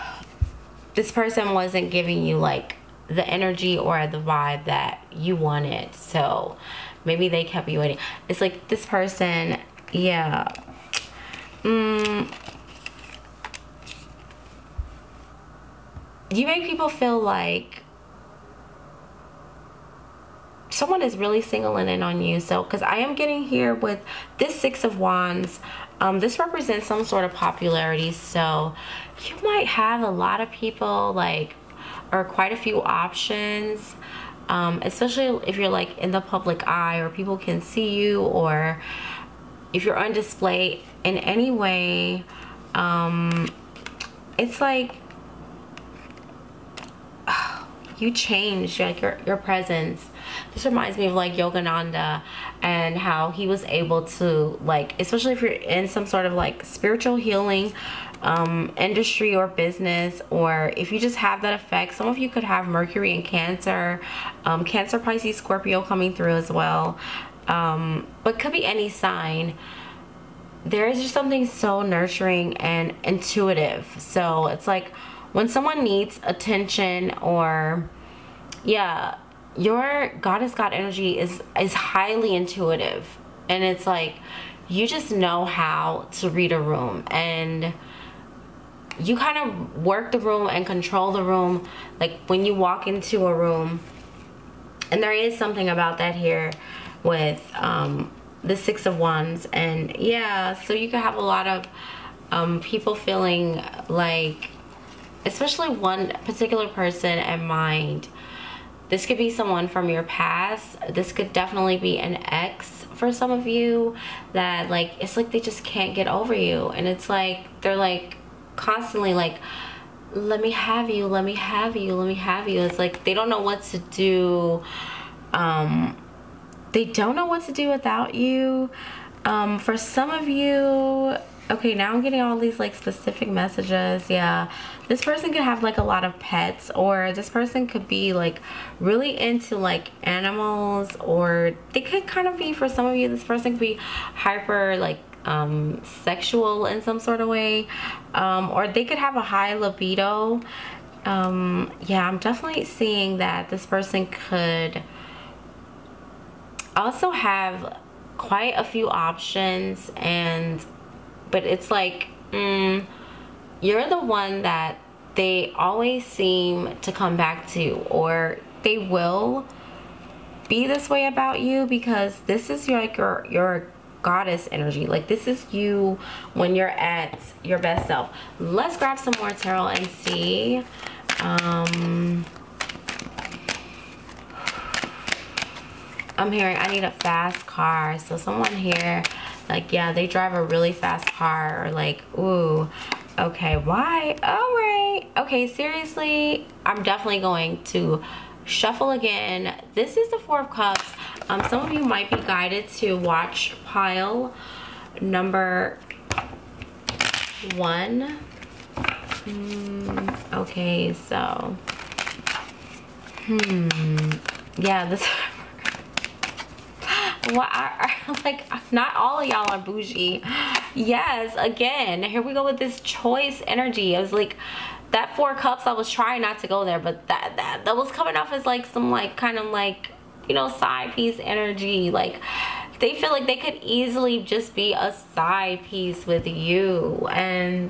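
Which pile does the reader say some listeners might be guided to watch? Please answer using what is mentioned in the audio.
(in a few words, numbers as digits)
1.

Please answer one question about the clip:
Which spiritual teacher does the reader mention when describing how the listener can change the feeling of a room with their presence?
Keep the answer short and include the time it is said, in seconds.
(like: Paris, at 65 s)
Yogananda, at 51 s.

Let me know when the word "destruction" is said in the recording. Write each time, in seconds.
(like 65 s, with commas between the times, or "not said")
not said.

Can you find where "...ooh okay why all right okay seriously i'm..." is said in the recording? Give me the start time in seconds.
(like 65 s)
192 s.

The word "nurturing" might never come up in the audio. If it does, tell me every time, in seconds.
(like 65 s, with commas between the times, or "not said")
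71 s.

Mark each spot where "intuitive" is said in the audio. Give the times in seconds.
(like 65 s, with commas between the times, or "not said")
73 s, 82 s.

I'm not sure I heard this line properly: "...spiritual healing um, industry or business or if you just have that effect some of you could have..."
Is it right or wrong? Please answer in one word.
right.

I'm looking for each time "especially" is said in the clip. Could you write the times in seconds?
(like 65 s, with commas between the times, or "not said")
34 s, 54 s, 105 s.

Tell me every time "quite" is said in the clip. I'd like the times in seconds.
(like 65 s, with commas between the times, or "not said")
32 s, 158 s.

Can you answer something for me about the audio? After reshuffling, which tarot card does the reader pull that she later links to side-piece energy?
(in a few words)
Four of Cups.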